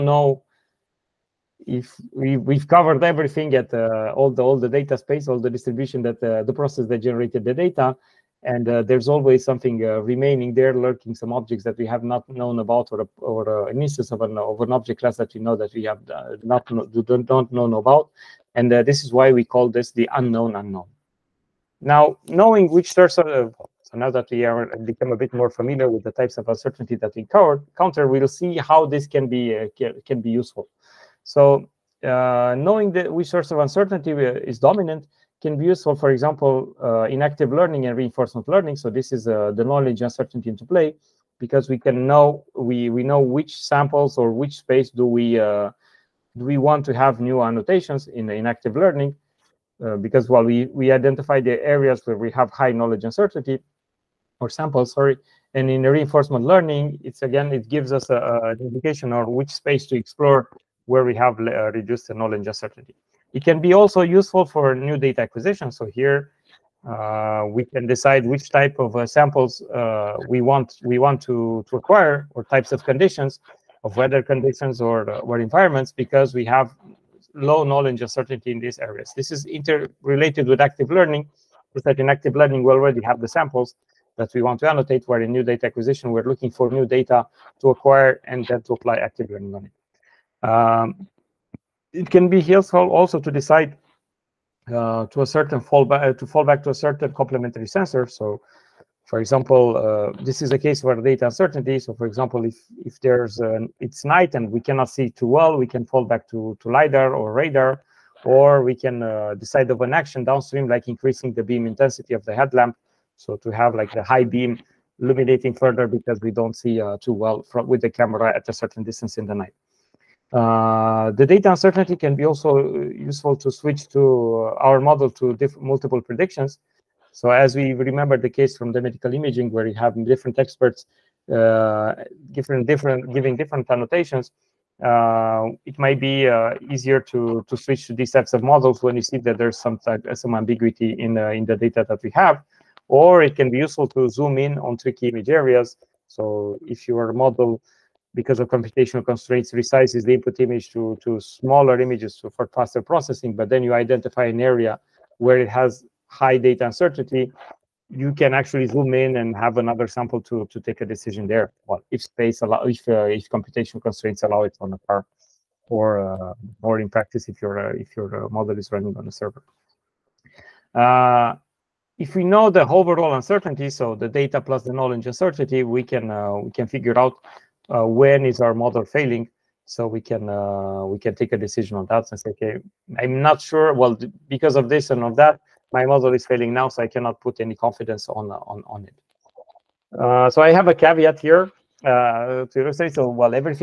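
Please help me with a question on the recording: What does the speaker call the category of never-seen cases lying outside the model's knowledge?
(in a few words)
the unknown unknown.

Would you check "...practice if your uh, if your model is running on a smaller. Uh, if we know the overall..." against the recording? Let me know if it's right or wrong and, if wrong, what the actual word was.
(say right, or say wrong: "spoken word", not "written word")
wrong: "server", not "smaller".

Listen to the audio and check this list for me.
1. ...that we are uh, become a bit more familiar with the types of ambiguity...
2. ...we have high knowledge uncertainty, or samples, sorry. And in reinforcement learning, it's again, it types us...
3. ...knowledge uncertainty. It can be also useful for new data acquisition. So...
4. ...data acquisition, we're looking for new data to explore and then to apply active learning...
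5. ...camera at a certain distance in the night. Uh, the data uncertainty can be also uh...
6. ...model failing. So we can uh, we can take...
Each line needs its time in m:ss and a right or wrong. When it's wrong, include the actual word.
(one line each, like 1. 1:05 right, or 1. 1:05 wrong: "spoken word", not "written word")
1. 0:24 wrong: "uncertainty", not "ambiguity"
2. 0:52 wrong: "gives", not "types"
3. 1:02 right
4. 1:25 wrong: "acquire", not "explore"
5. 1:57 right
6. 2:58 right.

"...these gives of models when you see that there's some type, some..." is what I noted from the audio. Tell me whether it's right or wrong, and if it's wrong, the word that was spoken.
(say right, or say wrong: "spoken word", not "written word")
wrong: "types", not "gives".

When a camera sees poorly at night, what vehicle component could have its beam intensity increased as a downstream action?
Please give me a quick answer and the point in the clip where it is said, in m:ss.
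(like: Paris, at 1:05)
the headlamp, at 1:52.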